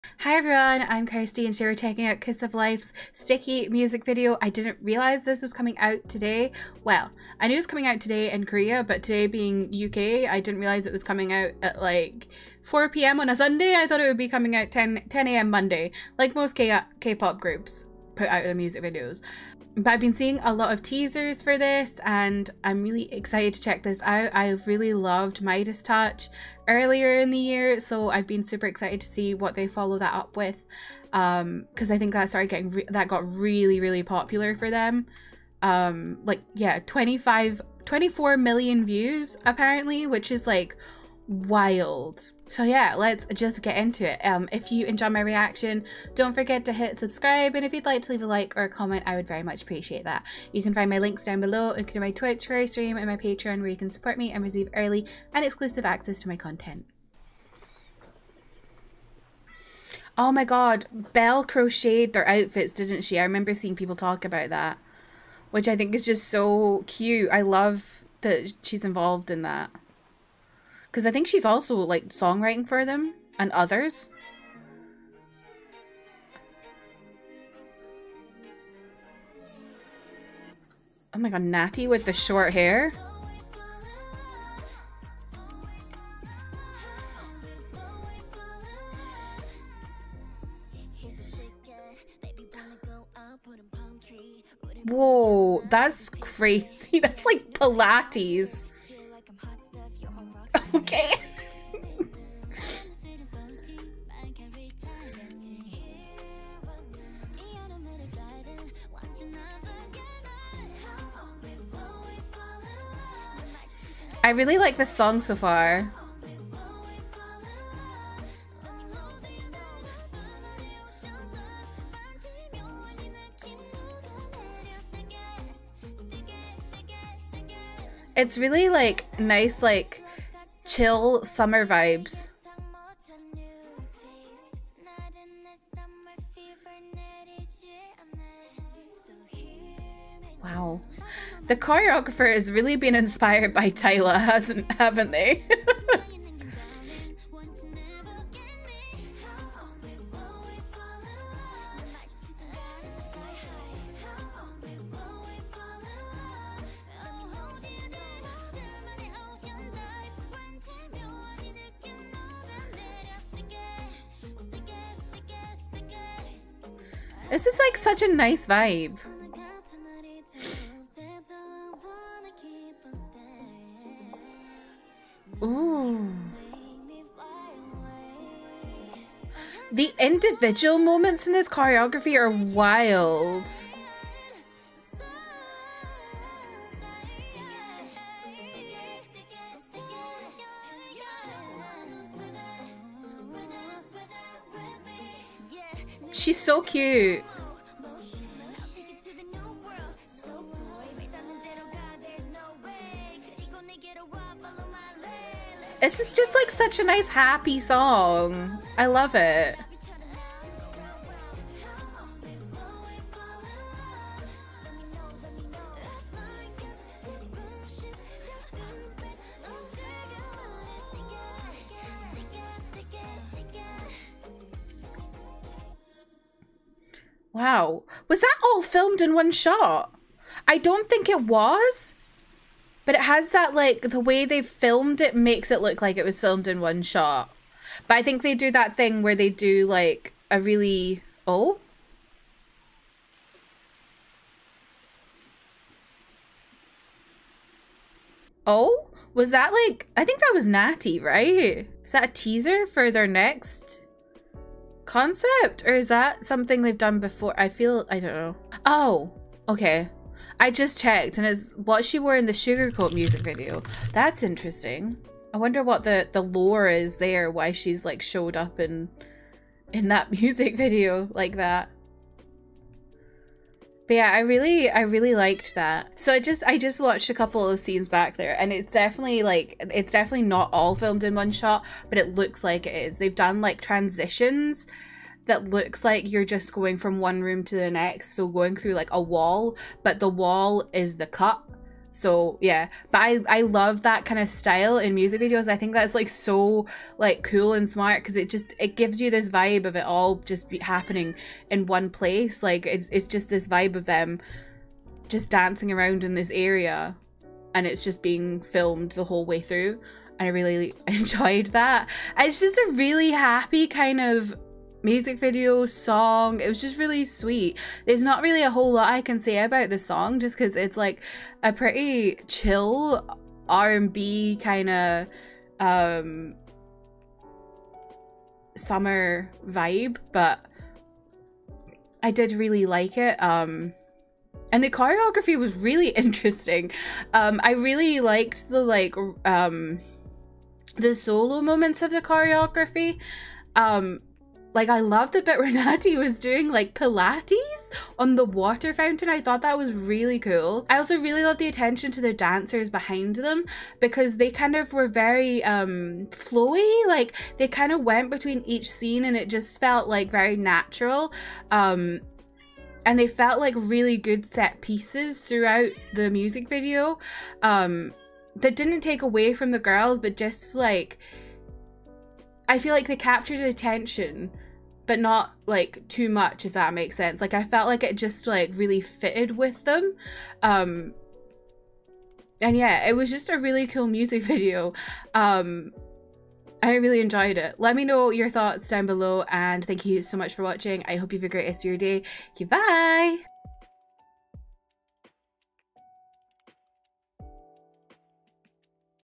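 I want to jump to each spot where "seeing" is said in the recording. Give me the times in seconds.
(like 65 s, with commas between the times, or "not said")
20 s, 63 s.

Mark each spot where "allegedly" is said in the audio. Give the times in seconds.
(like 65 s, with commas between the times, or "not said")
not said.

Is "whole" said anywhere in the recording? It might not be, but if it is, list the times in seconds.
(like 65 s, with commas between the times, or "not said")
309 s, 318 s.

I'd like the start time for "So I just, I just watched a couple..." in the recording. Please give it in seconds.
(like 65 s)
275 s.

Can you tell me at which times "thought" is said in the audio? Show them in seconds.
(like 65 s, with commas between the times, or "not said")
13 s, 349 s, 388 s.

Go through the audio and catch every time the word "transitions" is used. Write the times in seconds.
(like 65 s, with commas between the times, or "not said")
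283 s.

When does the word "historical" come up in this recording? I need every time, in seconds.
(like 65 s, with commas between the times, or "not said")
not said.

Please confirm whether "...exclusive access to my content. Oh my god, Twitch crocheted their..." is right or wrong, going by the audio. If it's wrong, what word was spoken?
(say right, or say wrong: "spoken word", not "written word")
wrong: "Belle", not "Twitch".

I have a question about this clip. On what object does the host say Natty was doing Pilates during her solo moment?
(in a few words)
Water fountain.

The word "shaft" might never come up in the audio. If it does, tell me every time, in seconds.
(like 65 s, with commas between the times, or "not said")
not said.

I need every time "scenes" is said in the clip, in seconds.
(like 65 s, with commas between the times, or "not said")
277 s, 358 s.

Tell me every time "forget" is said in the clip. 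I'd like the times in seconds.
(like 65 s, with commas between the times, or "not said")
46 s.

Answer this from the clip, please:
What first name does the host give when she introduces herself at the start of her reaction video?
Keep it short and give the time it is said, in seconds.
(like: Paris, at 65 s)
Kirsty, at 1 s.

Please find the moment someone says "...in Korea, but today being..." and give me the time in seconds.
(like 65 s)
8 s.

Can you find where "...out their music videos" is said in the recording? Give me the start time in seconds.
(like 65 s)
18 s.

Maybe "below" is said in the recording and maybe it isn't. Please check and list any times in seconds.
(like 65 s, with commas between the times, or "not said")
51 s, 388 s.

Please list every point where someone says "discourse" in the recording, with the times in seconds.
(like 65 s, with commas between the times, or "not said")
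not said.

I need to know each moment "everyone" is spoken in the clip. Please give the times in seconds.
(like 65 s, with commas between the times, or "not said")
0 s.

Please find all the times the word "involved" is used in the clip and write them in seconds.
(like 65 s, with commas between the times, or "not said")
68 s.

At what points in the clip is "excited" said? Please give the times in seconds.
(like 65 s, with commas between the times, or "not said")
23 s, 28 s.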